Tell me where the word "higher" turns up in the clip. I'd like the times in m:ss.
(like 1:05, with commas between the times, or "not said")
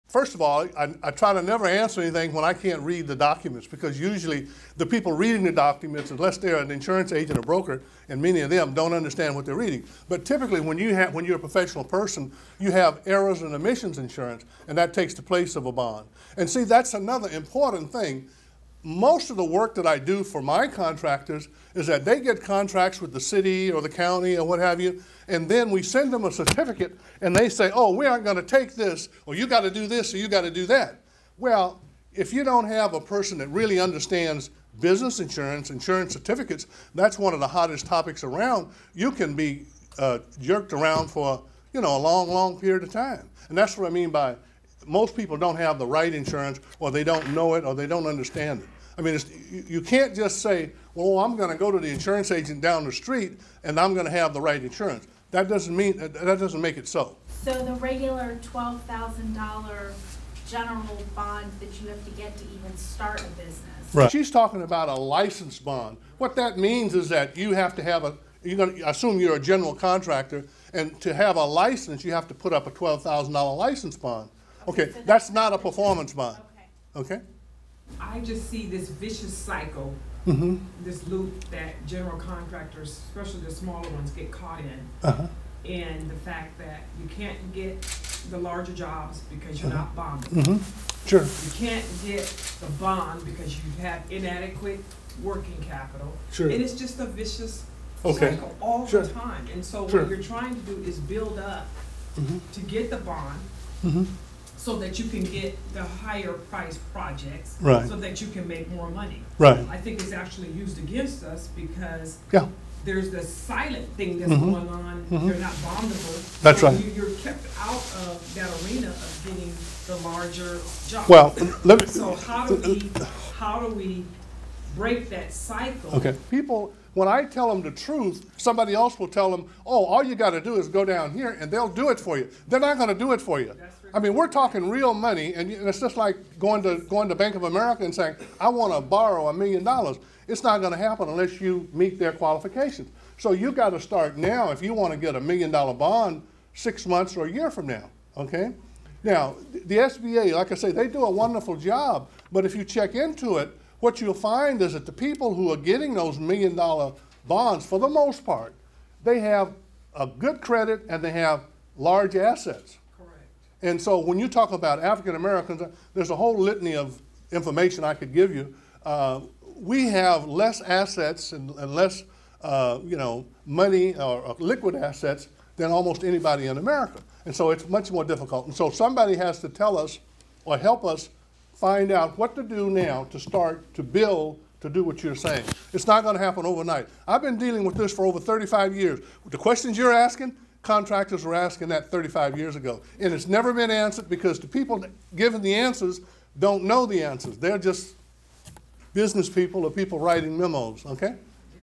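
1:45.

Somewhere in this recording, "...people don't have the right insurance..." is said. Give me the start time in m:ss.
0:45.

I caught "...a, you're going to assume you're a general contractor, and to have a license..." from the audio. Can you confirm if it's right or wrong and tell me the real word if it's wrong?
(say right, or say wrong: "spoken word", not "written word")
right.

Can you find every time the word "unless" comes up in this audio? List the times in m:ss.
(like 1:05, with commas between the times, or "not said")
0:06, 2:21.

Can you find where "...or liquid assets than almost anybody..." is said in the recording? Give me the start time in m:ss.
2:54.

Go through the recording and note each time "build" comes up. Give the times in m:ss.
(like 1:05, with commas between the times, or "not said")
1:41, 3:03.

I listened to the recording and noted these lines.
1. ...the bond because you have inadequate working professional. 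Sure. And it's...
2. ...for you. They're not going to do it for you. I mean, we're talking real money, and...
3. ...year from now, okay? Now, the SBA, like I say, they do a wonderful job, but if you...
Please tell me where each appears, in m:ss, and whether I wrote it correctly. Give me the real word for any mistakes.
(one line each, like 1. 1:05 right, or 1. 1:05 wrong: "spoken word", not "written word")
1. 1:32 wrong: "capital", not "professional"
2. 2:11 right
3. 2:27 right.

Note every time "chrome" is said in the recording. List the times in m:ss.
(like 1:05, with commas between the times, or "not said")
not said.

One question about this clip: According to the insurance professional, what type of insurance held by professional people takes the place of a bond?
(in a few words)
errors and omissions insurance.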